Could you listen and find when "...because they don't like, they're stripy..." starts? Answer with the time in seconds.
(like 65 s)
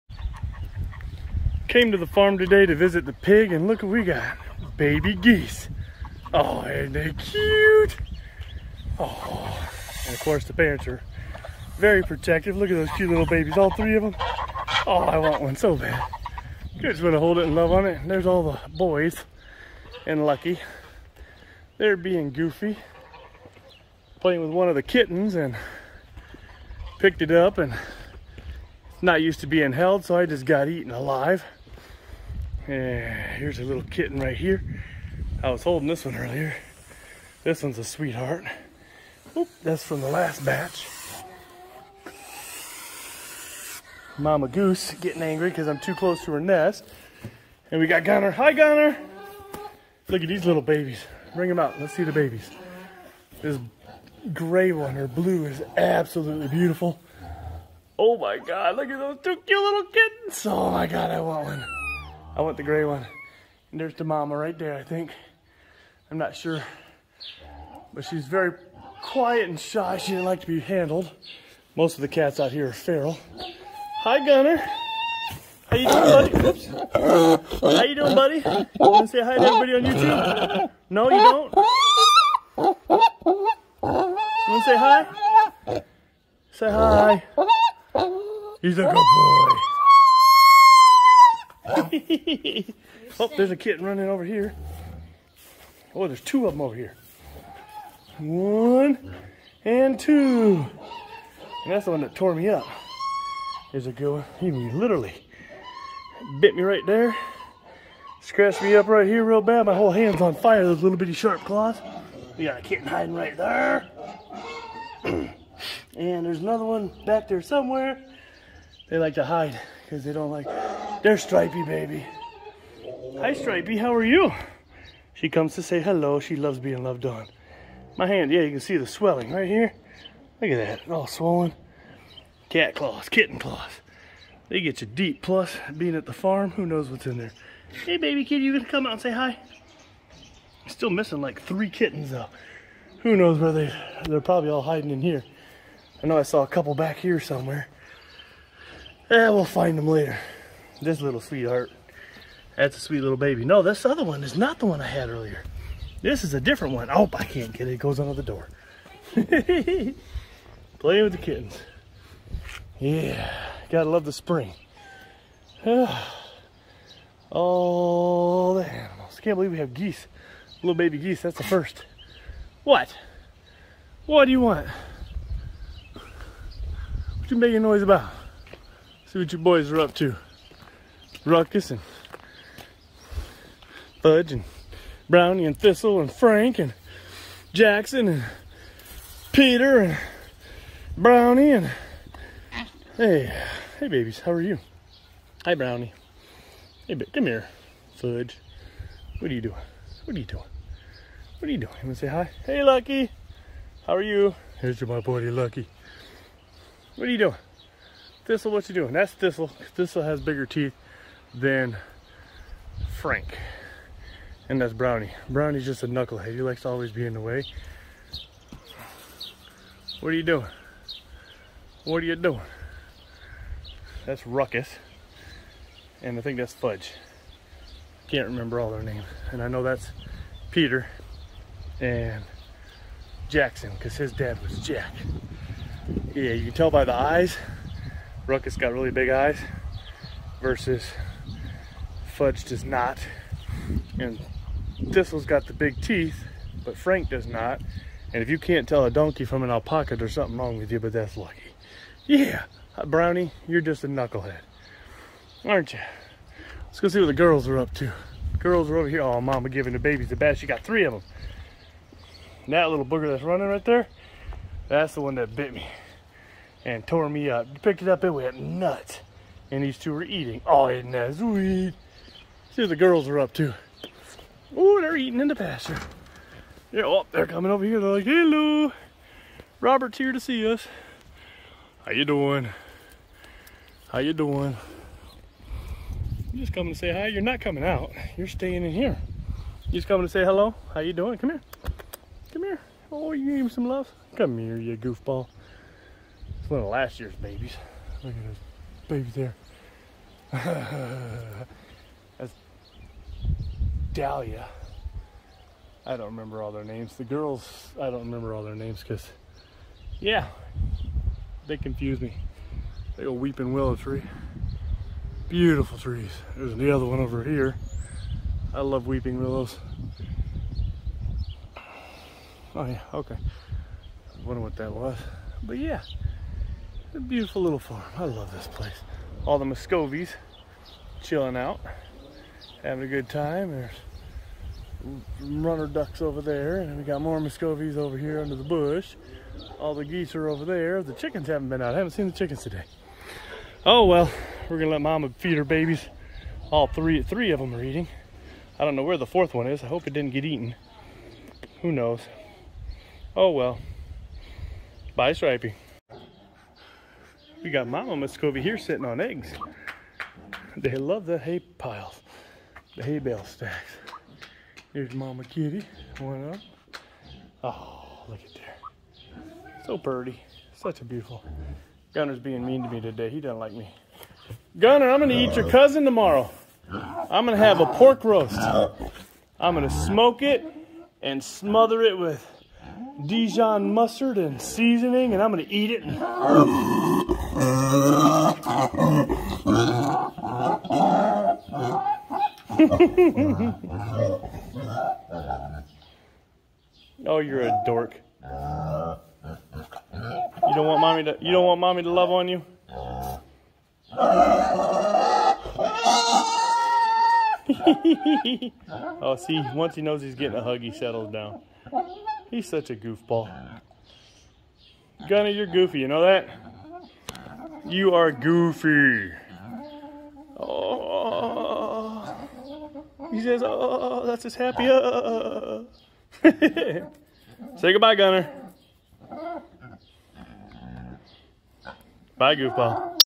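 119 s.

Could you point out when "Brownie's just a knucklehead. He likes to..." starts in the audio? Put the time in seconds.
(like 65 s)
215 s.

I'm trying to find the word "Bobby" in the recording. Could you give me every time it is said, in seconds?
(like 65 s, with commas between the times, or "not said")
not said.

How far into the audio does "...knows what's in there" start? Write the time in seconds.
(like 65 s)
136 s.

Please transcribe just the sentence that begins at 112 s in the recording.
We got a kitten hiding right there.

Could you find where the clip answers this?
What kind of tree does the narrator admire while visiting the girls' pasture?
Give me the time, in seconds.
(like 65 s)
313 s.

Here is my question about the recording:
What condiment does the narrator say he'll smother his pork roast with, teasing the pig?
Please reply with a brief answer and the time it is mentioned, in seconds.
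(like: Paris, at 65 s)
Dijon mustard, at 383 s.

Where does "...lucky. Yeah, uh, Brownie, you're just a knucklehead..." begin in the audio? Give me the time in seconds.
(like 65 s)
251 s.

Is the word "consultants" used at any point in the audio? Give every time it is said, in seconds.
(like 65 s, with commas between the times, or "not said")
not said.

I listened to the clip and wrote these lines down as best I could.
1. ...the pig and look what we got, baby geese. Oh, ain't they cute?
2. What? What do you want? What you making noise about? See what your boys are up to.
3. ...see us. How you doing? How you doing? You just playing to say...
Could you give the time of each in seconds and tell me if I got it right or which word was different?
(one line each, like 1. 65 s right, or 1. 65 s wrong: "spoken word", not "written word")
1. 3 s right
2. 172 s right
3. 280 s wrong: "coming", not "playing".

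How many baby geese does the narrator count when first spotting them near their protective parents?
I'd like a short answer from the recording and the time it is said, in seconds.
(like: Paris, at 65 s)
3, at 13 s.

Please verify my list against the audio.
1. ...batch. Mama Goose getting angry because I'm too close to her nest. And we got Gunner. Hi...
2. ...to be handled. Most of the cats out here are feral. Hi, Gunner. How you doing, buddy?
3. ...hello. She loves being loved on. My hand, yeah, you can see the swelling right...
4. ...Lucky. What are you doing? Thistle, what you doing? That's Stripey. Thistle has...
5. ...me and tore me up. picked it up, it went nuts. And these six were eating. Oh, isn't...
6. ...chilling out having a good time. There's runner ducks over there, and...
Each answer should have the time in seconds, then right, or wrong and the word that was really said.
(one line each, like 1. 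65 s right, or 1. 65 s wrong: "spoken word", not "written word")
1. 40 s right
2. 70 s right
3. 125 s right
4. 205 s wrong: "Thistle", not "Stripey"
5. 265 s wrong: "two", not "six"
6. 331 s right.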